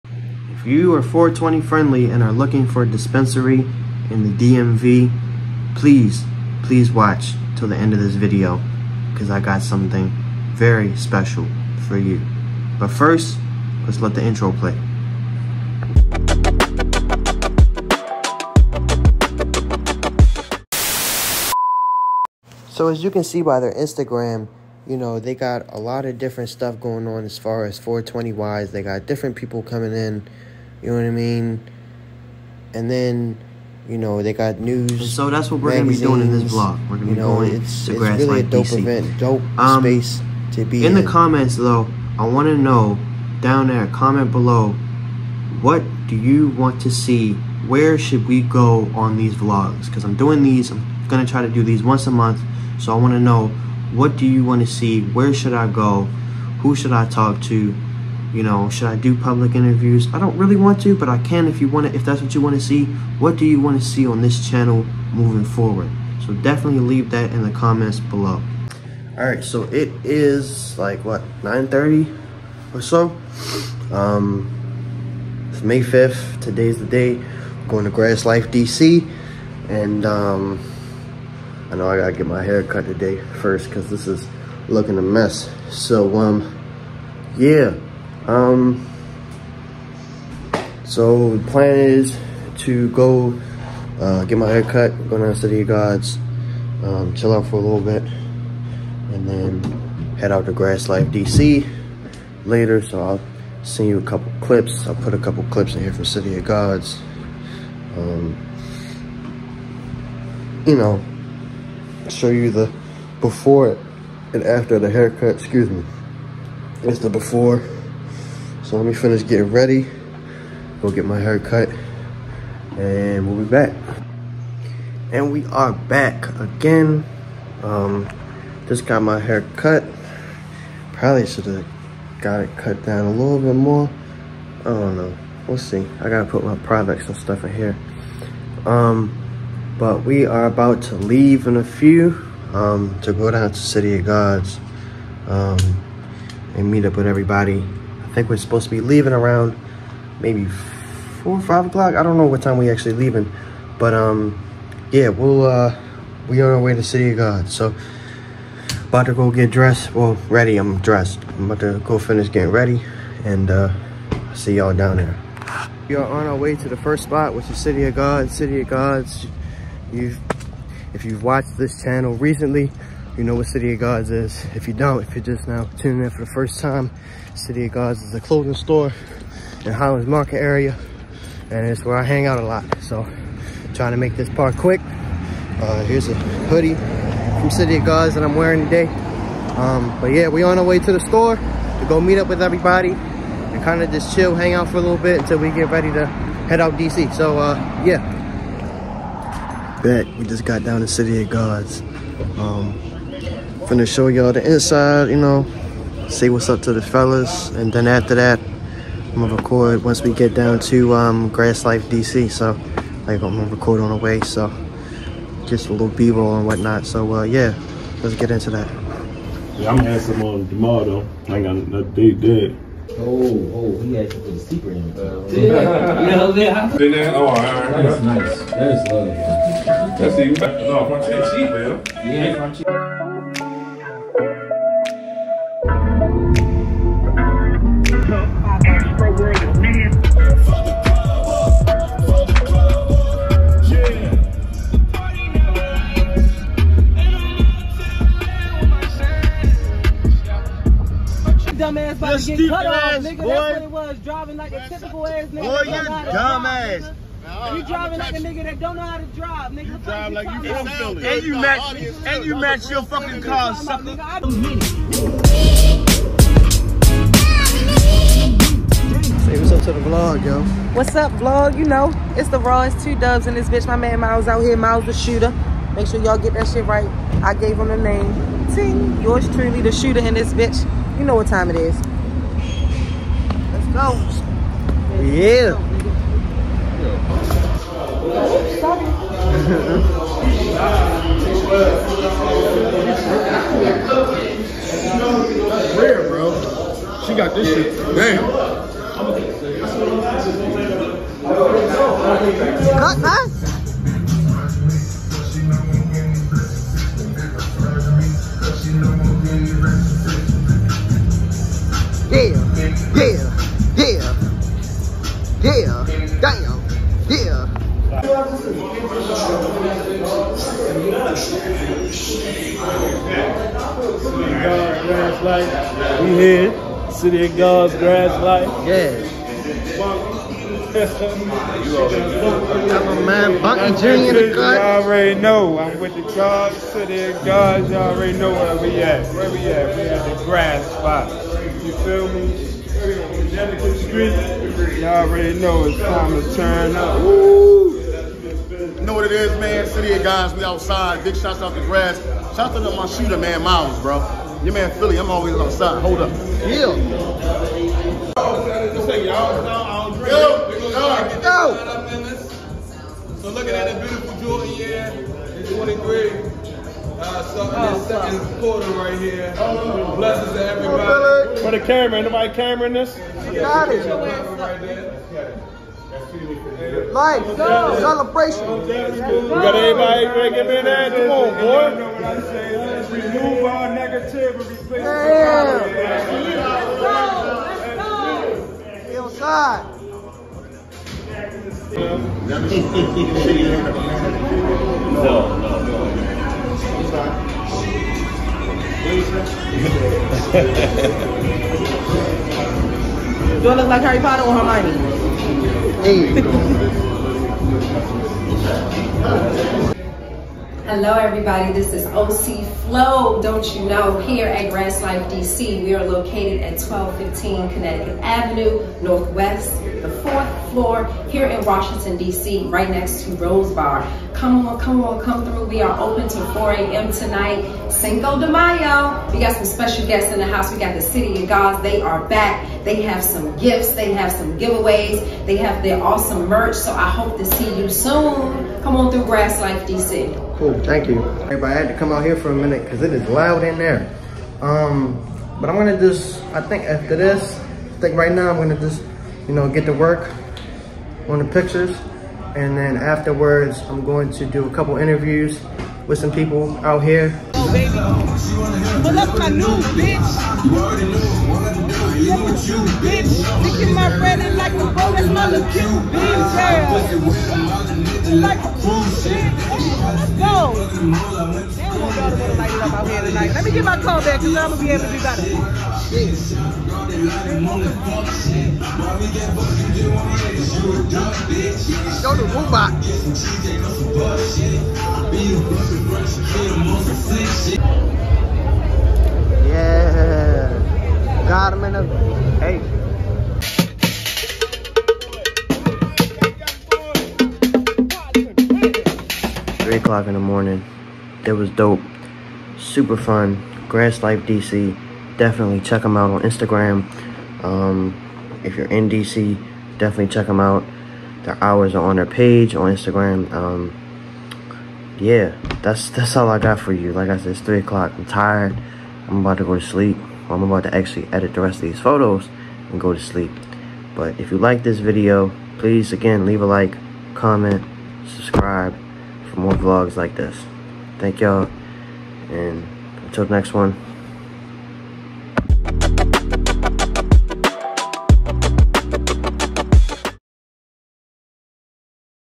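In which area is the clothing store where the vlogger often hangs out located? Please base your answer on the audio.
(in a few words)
Highlands Market.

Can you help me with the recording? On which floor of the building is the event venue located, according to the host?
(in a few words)
Fourth floor.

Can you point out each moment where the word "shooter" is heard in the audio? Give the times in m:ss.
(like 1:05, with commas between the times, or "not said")
4:34, 4:39, 5:52.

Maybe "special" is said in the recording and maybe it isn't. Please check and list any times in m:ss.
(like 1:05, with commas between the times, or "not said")
0:10, 7:09.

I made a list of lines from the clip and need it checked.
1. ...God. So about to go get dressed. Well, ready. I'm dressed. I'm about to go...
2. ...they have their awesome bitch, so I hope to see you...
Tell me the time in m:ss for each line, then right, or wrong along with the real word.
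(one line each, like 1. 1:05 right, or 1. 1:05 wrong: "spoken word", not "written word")
1. 2:37 right
2. 7:15 wrong: "merch", not "bitch".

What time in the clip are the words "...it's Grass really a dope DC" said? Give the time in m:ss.
0:37.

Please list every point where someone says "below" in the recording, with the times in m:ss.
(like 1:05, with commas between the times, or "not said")
0:44, 1:07.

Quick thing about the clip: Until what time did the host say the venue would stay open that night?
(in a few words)
4 a.m.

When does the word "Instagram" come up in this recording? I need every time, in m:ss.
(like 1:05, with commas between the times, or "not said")
0:23, 8:26, 8:32.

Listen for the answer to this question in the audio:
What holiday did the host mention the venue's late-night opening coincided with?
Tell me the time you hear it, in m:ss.
7:07.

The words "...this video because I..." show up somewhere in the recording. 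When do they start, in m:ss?
0:07.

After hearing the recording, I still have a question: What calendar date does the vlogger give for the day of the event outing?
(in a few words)
May 5th.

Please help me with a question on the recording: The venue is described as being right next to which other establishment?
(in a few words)
Rose Bar.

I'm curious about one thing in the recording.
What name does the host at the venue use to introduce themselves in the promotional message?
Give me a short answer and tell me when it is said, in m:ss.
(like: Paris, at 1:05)
OC Flow, at 6:51.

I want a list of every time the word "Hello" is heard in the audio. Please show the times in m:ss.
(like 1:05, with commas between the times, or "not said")
6:50.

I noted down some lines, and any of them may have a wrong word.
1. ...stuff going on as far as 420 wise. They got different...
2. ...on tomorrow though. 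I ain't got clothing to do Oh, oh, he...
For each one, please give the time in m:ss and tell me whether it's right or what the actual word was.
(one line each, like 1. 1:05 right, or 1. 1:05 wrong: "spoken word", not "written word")
1. 0:26 right
2. 3:40 wrong: "nothing", not "clothing".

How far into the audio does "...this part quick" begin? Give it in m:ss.
3:04.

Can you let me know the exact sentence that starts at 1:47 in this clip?
Um, you know, show you the before and after the haircut.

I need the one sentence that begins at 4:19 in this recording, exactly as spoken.
You drive like you from Philly.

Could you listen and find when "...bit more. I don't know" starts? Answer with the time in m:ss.
2:13.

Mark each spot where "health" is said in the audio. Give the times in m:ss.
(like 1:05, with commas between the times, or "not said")
not said.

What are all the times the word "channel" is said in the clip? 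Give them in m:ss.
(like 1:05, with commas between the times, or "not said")
1:04, 2:51.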